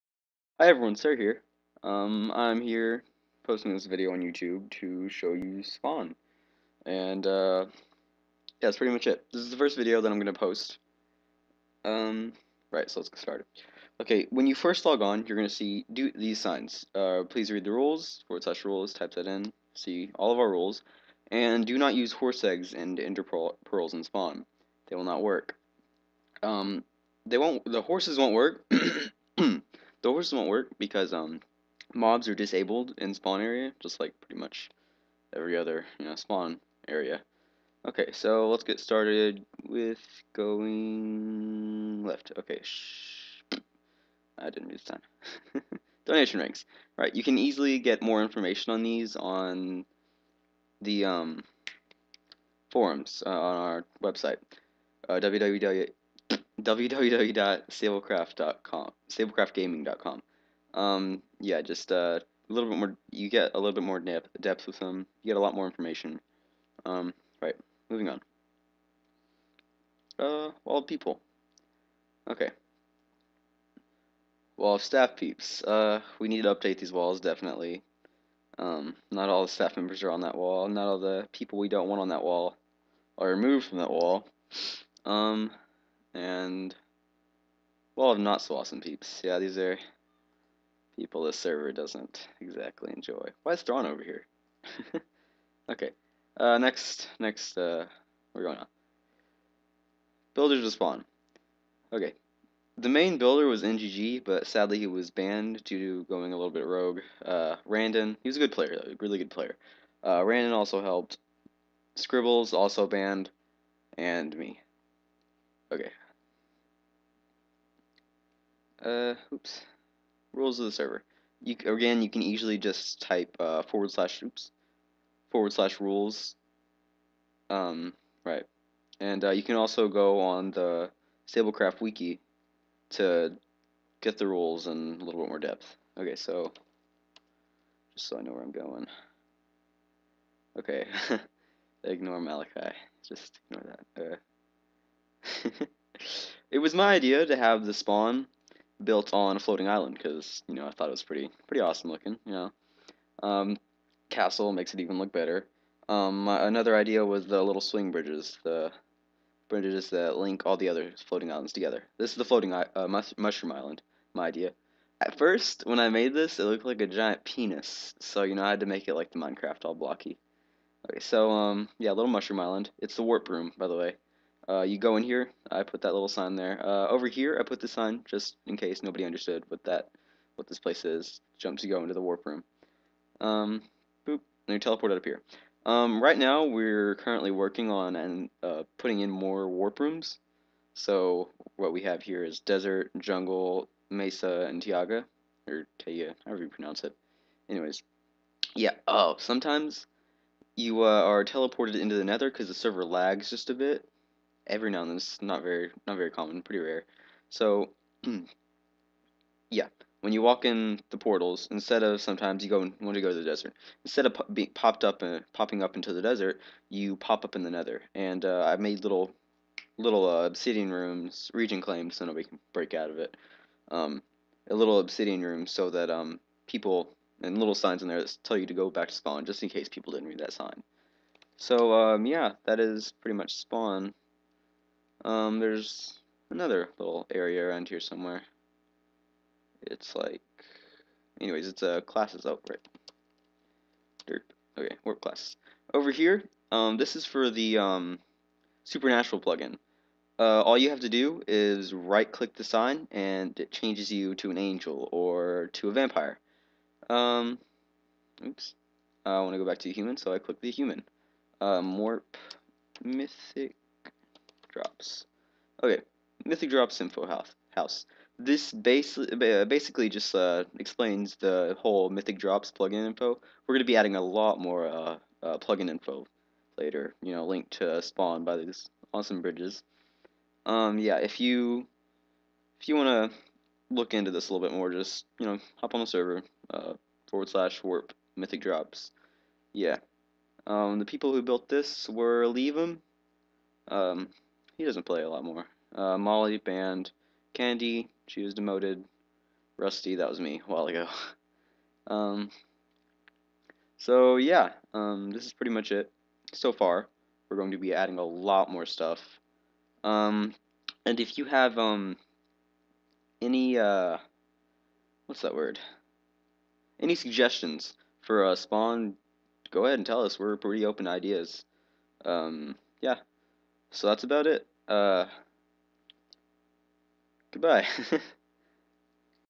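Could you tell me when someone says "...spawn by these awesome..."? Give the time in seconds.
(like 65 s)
277 s.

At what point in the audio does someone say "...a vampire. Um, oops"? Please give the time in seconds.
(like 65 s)
255 s.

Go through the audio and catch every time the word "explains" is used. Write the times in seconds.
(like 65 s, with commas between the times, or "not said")
270 s.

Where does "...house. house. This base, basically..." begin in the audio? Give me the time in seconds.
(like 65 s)
267 s.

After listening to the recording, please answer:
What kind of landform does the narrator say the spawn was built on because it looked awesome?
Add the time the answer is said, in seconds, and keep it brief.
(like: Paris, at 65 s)
Floating island, at 149 s.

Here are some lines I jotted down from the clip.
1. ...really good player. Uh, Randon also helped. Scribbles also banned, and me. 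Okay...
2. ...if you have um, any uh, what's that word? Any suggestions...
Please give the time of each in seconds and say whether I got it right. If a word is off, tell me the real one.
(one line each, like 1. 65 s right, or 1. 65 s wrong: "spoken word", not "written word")
1. 109 s right
2. 310 s right.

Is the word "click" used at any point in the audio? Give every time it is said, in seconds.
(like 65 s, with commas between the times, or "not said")
252 s, 260 s.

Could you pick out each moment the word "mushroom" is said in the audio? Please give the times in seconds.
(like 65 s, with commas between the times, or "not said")
163 s, 172 s.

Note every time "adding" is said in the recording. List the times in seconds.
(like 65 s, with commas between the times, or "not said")
273 s, 307 s.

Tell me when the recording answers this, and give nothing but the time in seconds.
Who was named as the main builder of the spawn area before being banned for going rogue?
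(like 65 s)
103 s.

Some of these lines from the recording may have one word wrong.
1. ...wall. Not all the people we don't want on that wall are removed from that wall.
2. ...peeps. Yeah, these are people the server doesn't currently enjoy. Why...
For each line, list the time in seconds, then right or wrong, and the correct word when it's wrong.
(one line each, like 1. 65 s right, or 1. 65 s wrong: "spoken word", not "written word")
1. 80 s right
2. 88 s wrong: "exactly", not "currently".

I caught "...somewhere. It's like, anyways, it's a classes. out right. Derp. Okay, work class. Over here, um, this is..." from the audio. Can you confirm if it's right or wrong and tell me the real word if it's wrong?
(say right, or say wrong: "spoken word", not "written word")
right.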